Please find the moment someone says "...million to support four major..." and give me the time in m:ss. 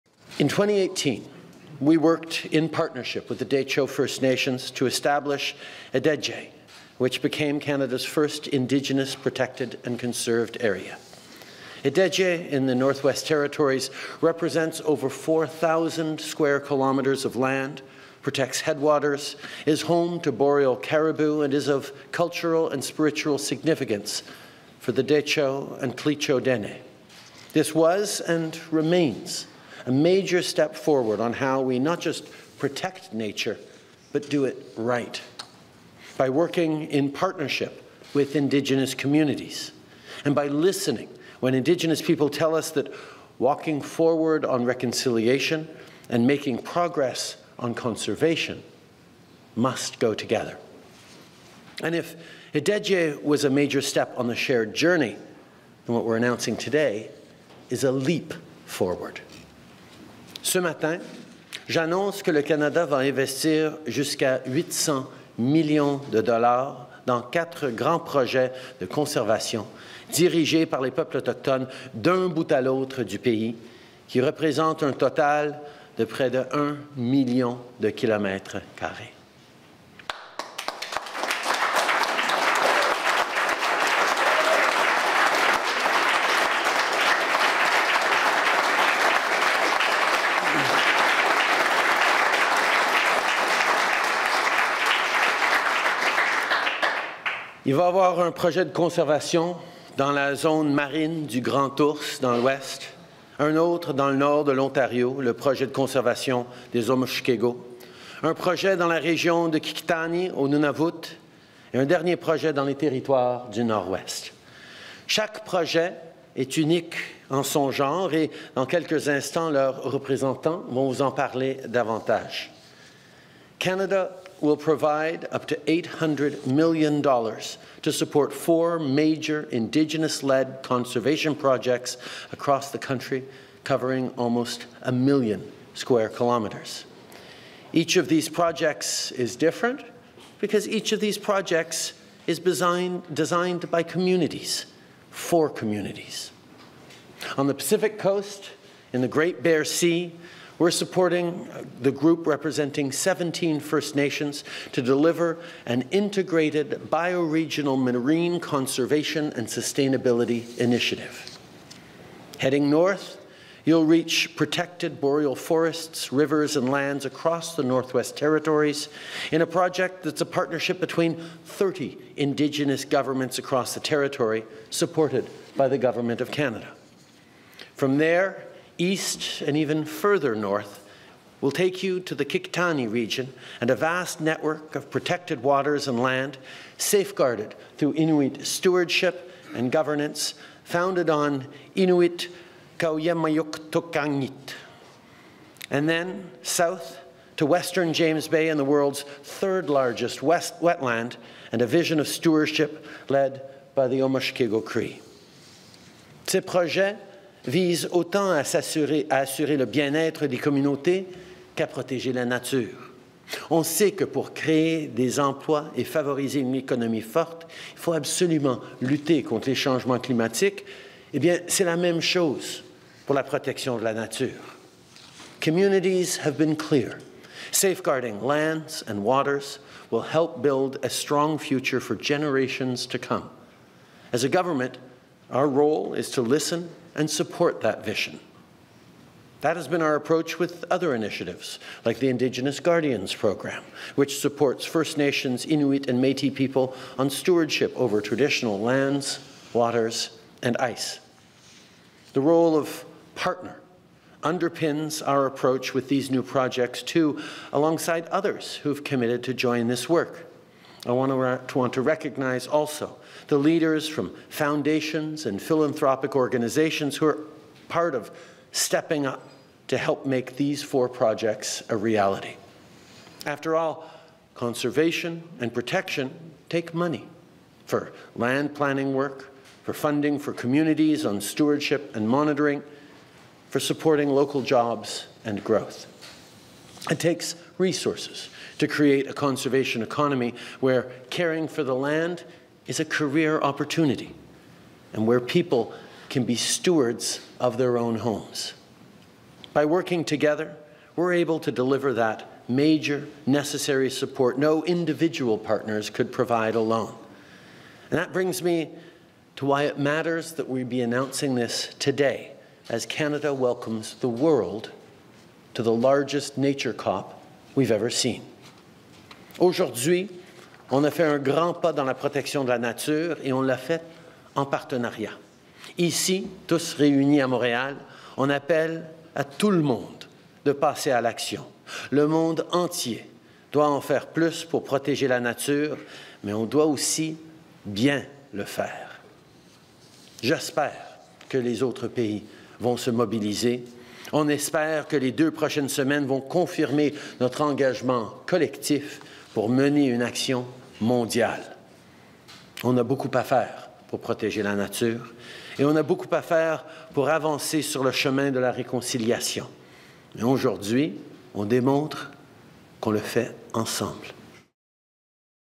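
2:06.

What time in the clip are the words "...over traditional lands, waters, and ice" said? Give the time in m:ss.
4:07.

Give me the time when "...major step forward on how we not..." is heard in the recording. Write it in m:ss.
0:29.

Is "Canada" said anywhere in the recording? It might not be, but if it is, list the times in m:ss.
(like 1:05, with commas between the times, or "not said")
0:07, 1:02, 2:03, 2:56, 5:12.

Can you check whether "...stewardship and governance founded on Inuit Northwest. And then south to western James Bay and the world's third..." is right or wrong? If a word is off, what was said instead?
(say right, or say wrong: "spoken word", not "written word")
wrong: "Qaujimajatuqangit", not "Northwest".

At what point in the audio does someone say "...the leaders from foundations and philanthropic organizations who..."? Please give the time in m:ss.
4:23.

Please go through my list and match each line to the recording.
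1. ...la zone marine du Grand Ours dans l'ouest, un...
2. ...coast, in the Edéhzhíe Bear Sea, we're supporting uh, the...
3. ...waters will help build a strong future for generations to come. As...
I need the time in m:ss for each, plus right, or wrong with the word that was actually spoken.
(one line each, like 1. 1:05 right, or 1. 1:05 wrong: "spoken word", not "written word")
1. 1:40 right
2. 2:27 wrong: "Great", not "Edéhzhíe"
3. 3:49 right.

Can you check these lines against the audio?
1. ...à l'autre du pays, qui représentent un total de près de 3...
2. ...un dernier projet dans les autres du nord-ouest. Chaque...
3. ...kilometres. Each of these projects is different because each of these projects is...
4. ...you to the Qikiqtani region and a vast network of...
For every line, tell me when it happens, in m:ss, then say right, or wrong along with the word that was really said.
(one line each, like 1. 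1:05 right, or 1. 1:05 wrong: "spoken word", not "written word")
1. 1:12 wrong: "1", not "3"
2. 1:51 wrong: "territoires", not "autres"
3. 2:16 right
4. 3:01 right.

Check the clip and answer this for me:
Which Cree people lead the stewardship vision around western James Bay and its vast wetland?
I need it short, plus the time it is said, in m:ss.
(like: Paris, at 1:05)
Omushkego Cree, at 3:23.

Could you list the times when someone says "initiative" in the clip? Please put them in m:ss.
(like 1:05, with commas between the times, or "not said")
2:40, 4:00.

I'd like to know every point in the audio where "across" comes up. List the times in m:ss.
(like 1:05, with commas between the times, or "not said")
2:12, 2:47, 2:53.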